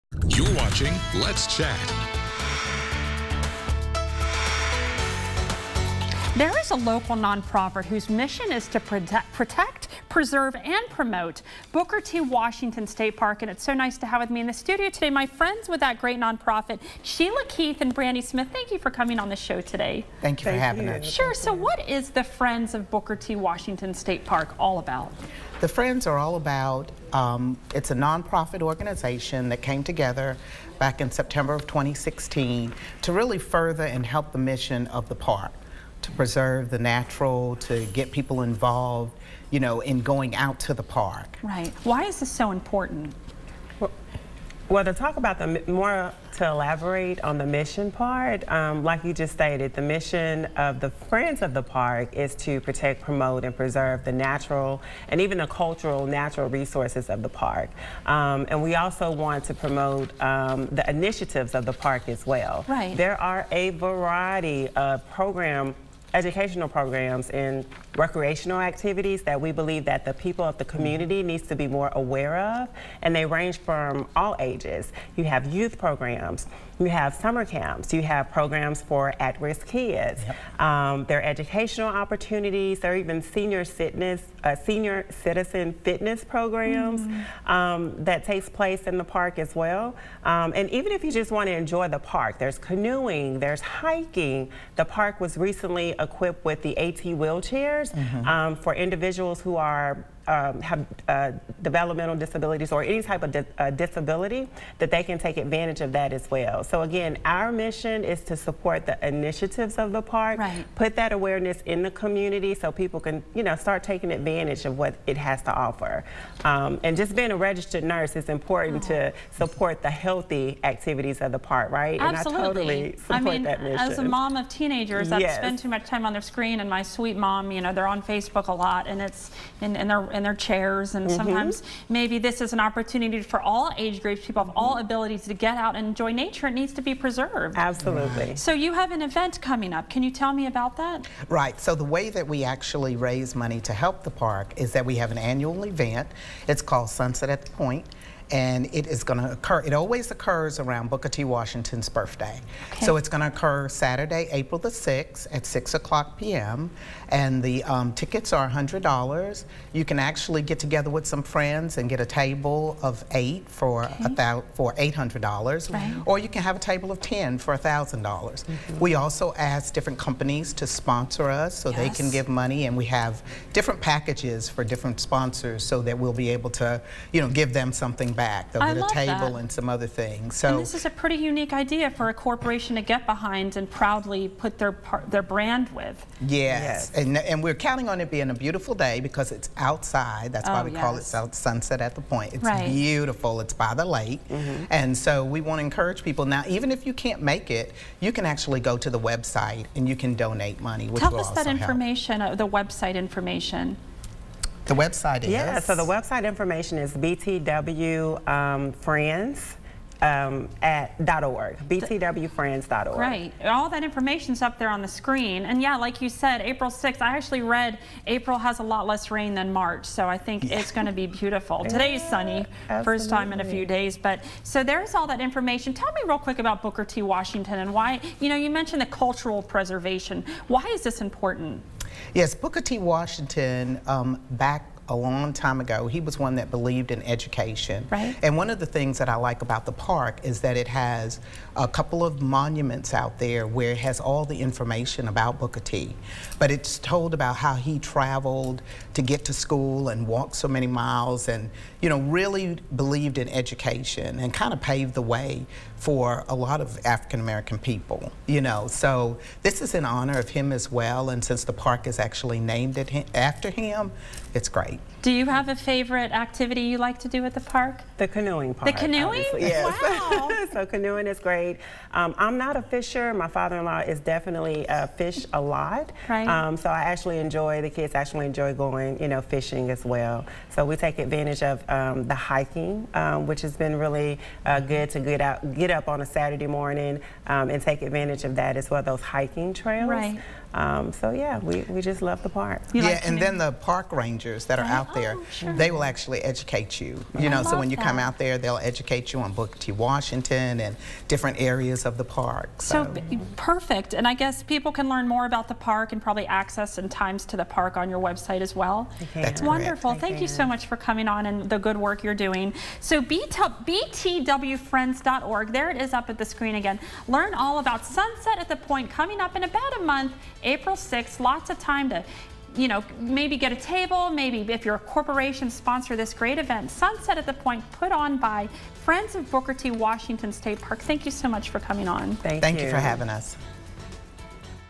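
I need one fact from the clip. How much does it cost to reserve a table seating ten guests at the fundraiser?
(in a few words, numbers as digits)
$1,000.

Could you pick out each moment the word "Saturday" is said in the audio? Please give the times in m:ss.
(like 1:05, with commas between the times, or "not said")
2:33, 4:46.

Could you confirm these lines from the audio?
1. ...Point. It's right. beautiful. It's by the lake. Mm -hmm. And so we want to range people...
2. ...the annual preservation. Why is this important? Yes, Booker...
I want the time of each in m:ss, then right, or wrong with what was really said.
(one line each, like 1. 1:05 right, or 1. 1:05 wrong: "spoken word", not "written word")
1. 3:12 wrong: "encourage", not "range"
2. 3:48 wrong: "cultural", not "annual".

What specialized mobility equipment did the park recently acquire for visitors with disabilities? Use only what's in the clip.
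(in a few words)
AT wheelchair.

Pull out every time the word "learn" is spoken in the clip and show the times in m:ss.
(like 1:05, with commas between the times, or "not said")
5:04, 5:17.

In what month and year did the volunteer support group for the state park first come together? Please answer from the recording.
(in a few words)
September 2016.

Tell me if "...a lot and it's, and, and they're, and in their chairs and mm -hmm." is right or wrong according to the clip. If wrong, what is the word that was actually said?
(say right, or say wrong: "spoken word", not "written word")
right.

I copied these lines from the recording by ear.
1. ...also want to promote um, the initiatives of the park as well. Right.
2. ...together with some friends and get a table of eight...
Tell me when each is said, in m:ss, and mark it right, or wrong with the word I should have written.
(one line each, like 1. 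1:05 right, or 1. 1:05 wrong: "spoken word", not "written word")
1. 0:58 right
2. 2:40 right.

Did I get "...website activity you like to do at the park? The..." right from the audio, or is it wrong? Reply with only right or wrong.
wrong.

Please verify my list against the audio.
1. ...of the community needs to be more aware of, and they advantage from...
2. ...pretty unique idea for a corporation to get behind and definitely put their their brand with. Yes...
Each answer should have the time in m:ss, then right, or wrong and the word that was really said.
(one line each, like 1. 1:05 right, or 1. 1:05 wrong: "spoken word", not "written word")
1. 1:10 wrong: "range", not "advantage"
2. 3:00 wrong: "proudly", not "definitely".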